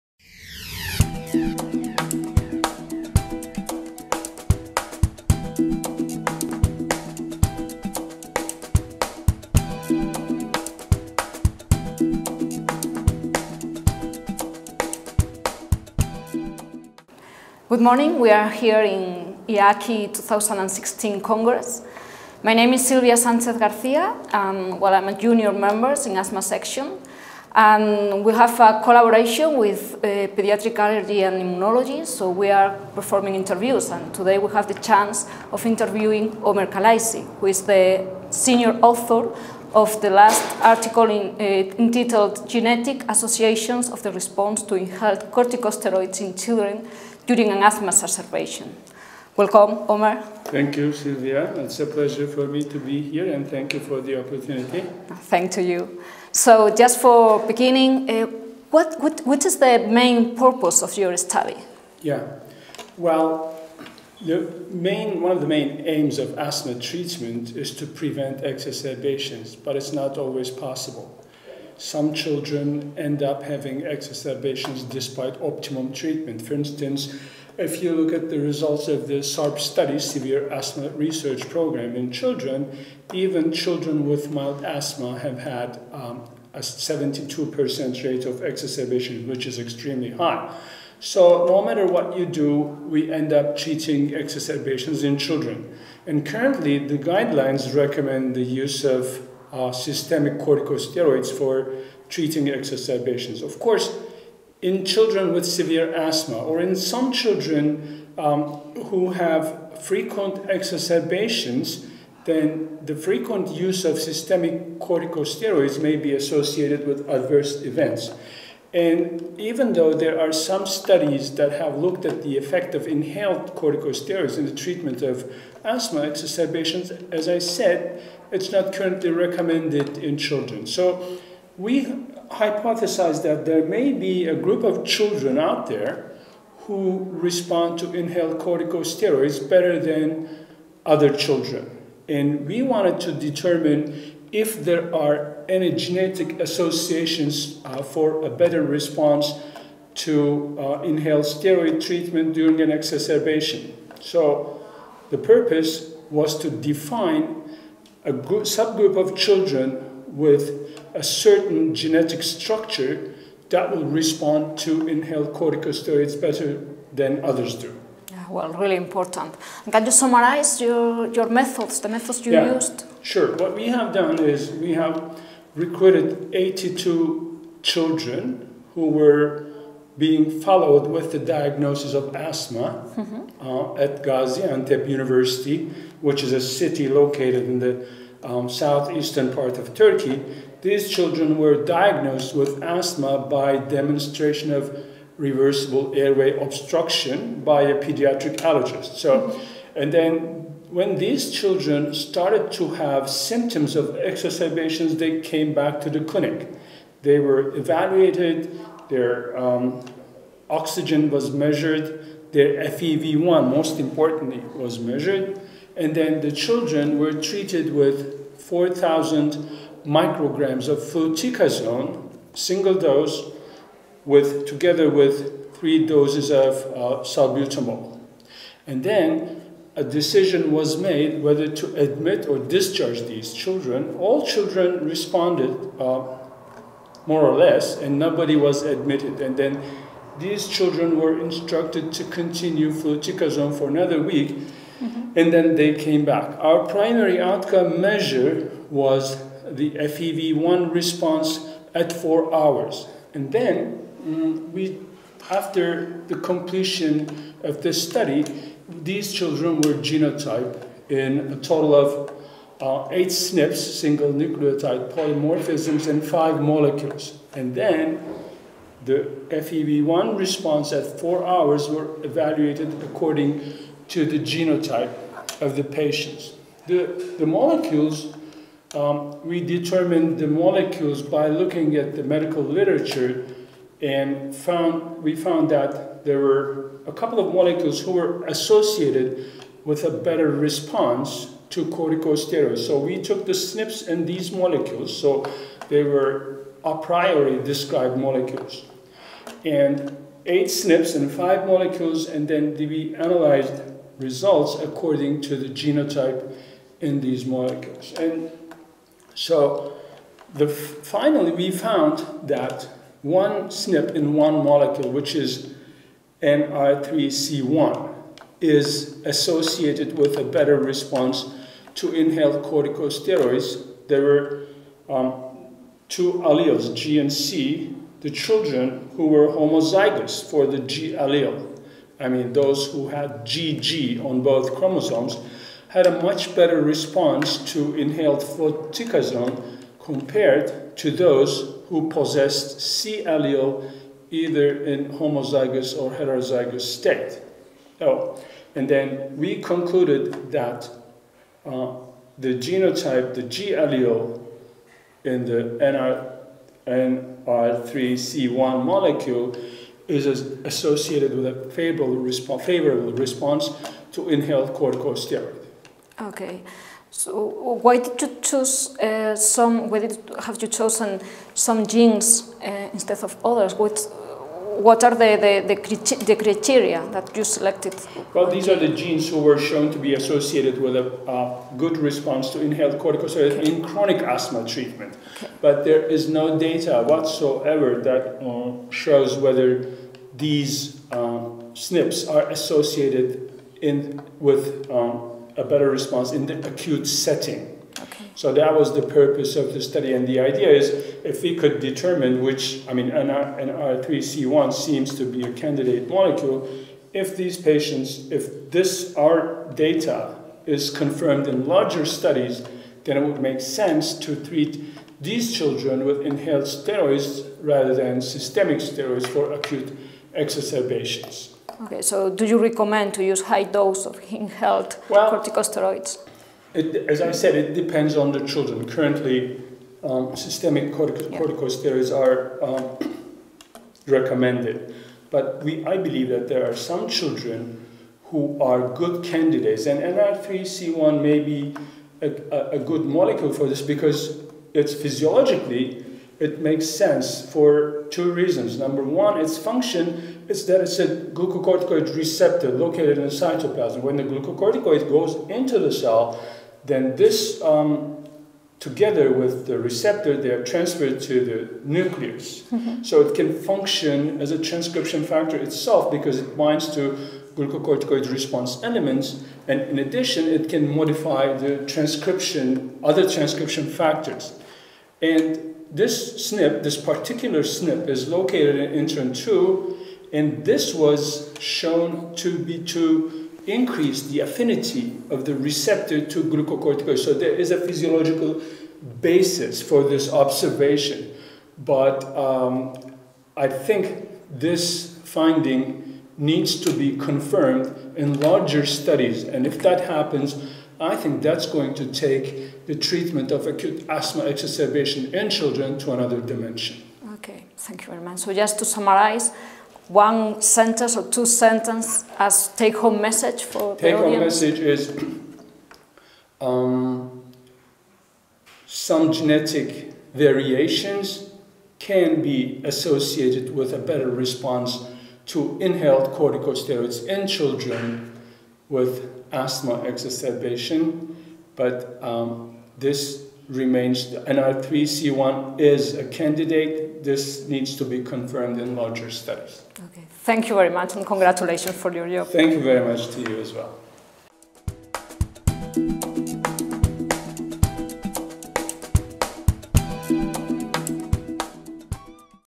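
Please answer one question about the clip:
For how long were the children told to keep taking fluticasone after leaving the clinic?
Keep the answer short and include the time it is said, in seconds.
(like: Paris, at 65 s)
1 week, at 243 s.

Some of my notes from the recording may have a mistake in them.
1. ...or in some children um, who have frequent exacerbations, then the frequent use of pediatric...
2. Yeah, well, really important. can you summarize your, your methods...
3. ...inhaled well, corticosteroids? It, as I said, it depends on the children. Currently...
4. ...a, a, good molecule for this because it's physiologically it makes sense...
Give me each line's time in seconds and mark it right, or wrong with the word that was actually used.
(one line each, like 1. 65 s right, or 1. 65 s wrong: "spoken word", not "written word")
1. 106 s wrong: "systemic", not "pediatric"
2. 168 s right
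3. 424 s right
4. 442 s right.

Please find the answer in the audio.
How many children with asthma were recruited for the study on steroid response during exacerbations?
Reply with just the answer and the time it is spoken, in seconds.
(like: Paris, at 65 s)
82, at 176 s.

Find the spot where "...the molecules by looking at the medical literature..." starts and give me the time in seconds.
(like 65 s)
280 s.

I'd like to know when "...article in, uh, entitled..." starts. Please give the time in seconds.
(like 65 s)
40 s.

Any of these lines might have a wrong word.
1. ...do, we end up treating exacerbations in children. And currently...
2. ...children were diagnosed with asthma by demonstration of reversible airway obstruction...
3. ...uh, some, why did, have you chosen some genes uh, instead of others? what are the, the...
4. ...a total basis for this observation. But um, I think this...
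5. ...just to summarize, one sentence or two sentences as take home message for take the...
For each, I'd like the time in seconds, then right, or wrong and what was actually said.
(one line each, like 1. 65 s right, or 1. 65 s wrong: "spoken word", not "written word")
1. 92 s right
2. 190 s right
3. 368 s right
4. 487 s wrong: "physiological", not "total"
5. 508 s right.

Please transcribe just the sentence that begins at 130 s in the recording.
So we hypothesize that there may be a group of children out there who respond to inhaled corticosteroids better than other children.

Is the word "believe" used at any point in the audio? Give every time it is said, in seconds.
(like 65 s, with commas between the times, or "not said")
435 s.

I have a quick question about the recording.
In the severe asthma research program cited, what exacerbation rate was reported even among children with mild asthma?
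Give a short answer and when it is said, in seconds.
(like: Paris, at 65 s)
72%, at 86 s.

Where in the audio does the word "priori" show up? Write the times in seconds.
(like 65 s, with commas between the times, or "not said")
296 s.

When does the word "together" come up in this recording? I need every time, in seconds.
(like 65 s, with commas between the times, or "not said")
224 s, 458 s.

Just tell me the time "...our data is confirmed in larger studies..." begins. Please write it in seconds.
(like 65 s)
408 s.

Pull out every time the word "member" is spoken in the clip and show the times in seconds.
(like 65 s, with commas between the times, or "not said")
25 s.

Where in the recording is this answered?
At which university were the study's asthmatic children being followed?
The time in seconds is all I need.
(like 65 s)
184 s.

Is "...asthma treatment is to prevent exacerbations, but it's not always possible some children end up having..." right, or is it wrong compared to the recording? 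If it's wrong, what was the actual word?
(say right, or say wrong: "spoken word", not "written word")
right.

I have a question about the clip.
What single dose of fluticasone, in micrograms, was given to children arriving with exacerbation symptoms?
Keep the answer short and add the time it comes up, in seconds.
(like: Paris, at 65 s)
4,000 micrograms, at 218 s.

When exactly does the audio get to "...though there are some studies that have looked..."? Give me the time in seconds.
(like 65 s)
119 s.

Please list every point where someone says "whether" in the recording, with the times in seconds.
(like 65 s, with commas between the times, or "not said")
231 s, 389 s.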